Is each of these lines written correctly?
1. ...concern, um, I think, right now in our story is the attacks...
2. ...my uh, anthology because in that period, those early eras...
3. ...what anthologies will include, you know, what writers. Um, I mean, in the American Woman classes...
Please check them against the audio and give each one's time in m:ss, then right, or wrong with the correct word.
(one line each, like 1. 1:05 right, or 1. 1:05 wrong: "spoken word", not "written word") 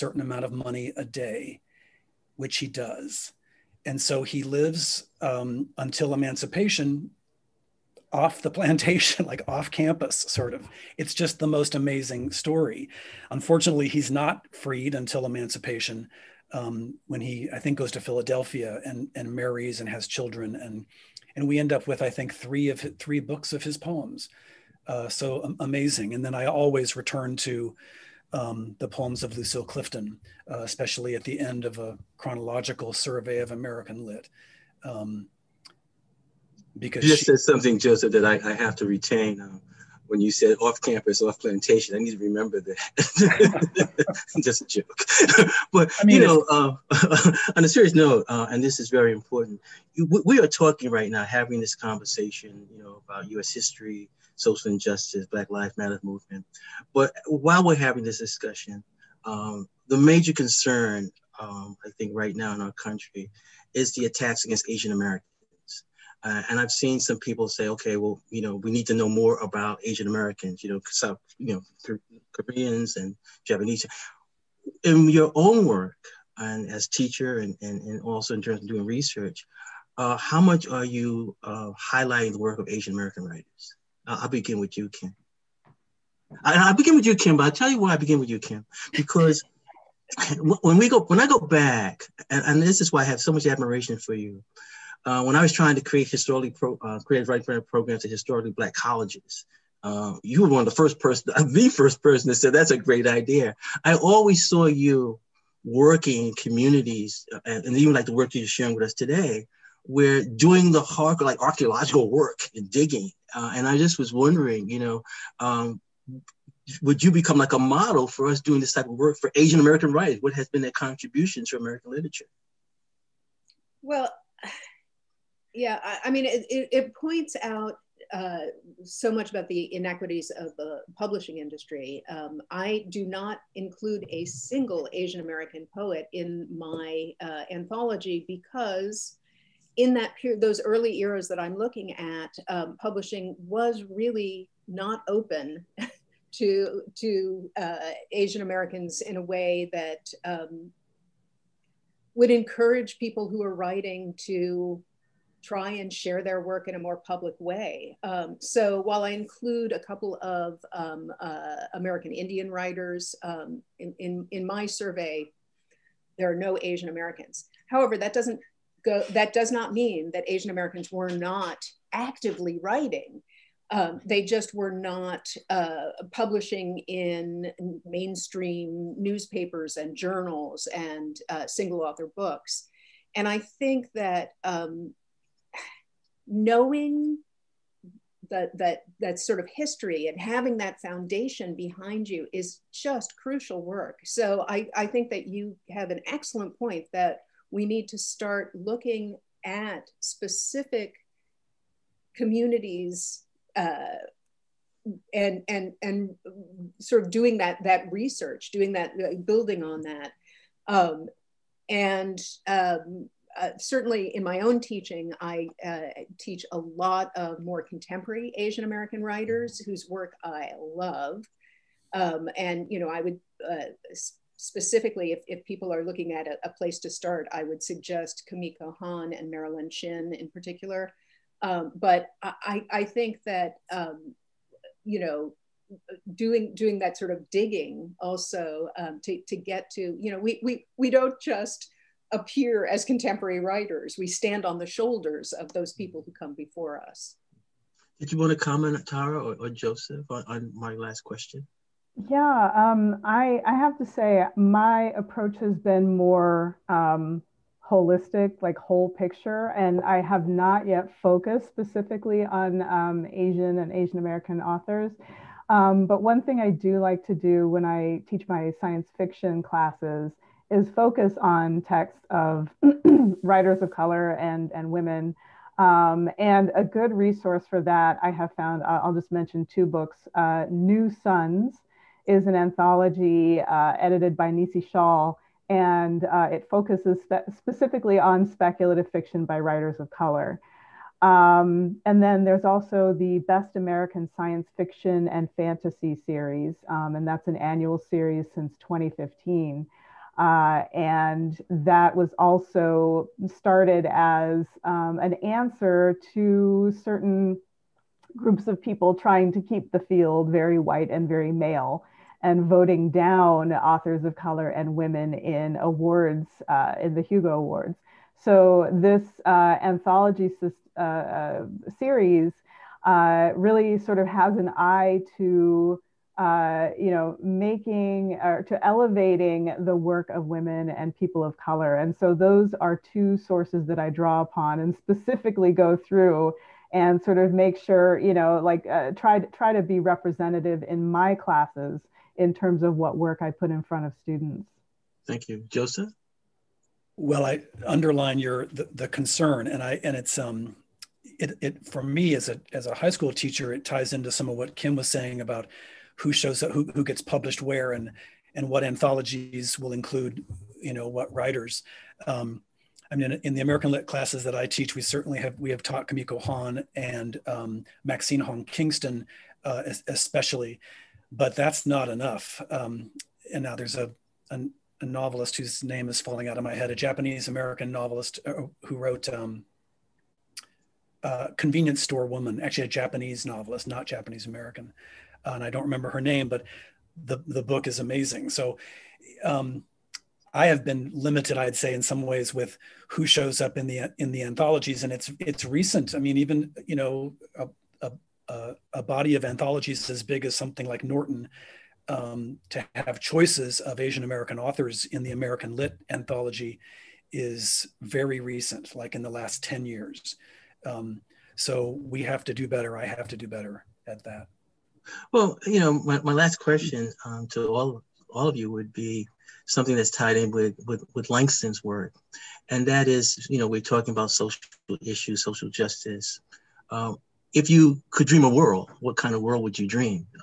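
1. 1:00 wrong: "country", not "story"
2. 2:16 right
3. 5:58 wrong: "Lit", not "Woman".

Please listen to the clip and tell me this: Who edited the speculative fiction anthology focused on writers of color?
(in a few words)
Nisi Shawl.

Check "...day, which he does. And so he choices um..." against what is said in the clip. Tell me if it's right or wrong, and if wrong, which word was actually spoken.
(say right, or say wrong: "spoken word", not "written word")
wrong: "lives", not "choices".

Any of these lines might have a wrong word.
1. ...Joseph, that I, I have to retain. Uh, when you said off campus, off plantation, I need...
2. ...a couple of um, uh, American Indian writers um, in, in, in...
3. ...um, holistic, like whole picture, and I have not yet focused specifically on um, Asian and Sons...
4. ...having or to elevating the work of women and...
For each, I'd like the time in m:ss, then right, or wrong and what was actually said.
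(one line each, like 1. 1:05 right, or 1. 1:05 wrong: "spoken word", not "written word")
1. 0:37 right
2. 2:39 right
3. 4:16 wrong: "Asian", not "Sons"
4. 5:27 wrong: "making", not "having".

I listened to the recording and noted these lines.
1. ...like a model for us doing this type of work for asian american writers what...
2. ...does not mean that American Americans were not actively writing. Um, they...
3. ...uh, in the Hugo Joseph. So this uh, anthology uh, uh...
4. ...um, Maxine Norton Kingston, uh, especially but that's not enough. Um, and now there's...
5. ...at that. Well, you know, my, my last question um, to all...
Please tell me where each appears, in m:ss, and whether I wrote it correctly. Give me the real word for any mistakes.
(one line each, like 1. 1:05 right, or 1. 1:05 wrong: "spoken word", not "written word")
1. 1:57 right
2. 2:49 wrong: "Asian", not "American"
3. 5:16 wrong: "Awards", not "Joseph"
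4. 6:07 wrong: "Hong", not "Norton"
5. 6:53 right.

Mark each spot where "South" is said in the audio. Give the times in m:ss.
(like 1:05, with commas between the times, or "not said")
1:10.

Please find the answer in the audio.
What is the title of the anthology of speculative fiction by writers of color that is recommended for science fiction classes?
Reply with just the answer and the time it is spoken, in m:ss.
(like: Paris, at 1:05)
New Sons, at 4:40.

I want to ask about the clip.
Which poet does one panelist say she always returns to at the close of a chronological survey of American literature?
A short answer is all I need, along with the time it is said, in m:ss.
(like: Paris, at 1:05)
Lucille Clifton, at 0:29.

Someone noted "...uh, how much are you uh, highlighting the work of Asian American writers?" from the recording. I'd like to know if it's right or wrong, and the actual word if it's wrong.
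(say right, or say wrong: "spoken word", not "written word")
right.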